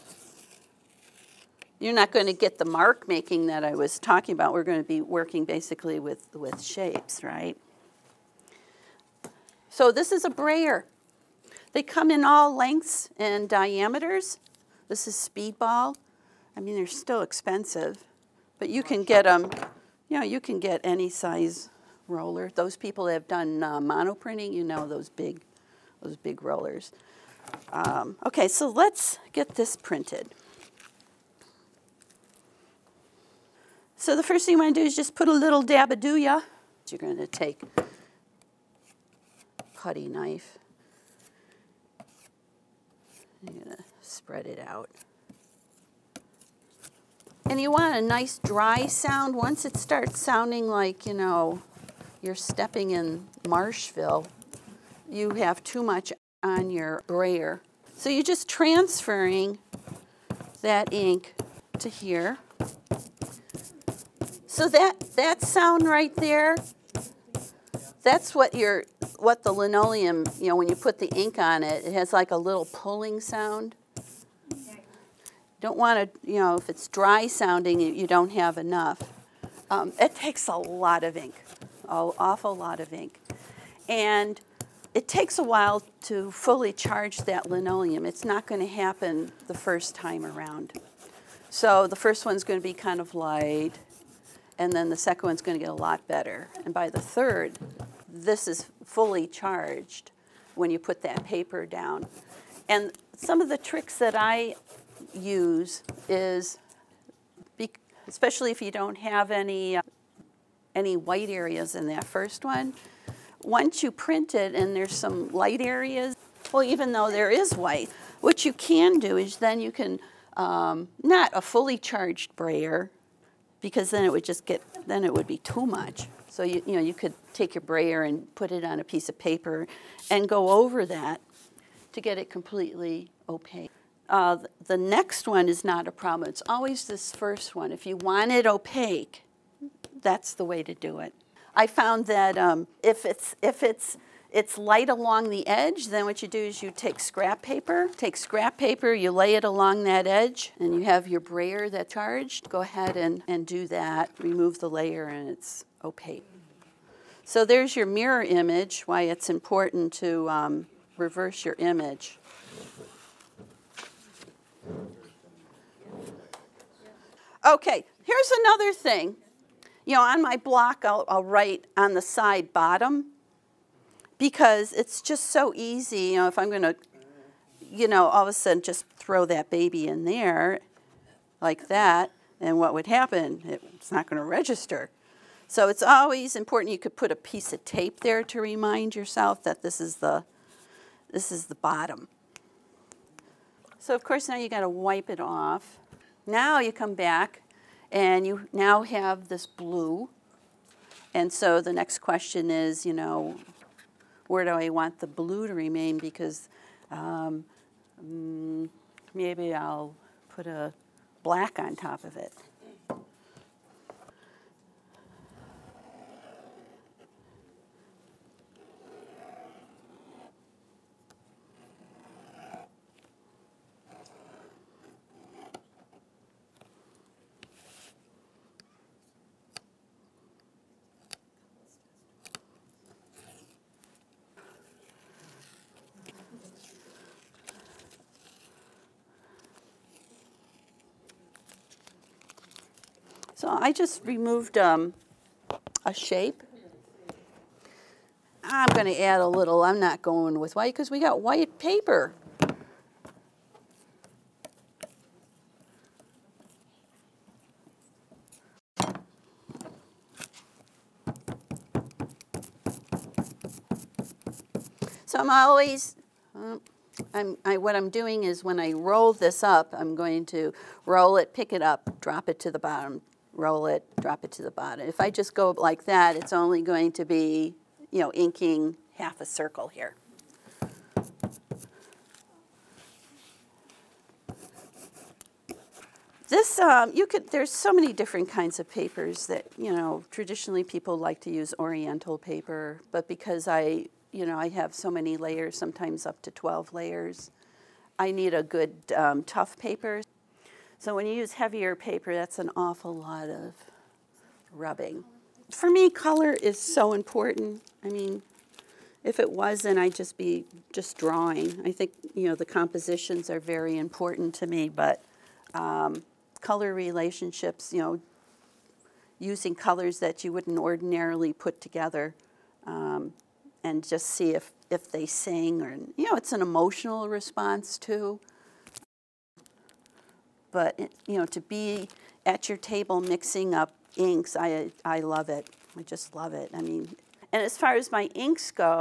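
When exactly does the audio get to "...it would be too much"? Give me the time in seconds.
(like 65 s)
125 s.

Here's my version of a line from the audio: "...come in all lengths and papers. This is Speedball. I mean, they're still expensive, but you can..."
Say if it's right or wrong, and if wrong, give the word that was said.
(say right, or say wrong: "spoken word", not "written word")
wrong: "diameters", not "papers".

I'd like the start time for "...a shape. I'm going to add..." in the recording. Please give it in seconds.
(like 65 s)
245 s.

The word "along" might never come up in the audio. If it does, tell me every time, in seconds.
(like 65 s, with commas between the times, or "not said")
144 s, 149 s.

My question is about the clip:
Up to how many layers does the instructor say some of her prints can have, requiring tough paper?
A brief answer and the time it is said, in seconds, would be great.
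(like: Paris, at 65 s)
12, at 296 s.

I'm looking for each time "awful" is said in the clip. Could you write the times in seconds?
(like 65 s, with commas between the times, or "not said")
82 s, 302 s.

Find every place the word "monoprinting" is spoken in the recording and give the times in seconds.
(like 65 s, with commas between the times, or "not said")
23 s.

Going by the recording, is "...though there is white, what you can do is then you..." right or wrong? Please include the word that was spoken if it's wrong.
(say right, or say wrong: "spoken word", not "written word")
right.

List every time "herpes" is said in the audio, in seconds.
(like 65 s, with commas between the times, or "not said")
not said.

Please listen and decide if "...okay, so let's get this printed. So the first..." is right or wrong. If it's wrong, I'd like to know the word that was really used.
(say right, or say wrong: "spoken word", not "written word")
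right.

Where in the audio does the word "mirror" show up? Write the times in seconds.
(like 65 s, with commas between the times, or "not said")
157 s.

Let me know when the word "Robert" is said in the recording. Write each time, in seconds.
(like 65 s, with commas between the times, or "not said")
not said.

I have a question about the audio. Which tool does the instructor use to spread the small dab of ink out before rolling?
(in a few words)
Putty knife.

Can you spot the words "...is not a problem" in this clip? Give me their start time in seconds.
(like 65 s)
135 s.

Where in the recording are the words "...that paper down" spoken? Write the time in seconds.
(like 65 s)
101 s.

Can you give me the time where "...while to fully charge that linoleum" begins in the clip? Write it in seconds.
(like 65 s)
85 s.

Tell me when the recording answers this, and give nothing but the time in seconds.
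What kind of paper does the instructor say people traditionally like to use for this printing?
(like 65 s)
291 s.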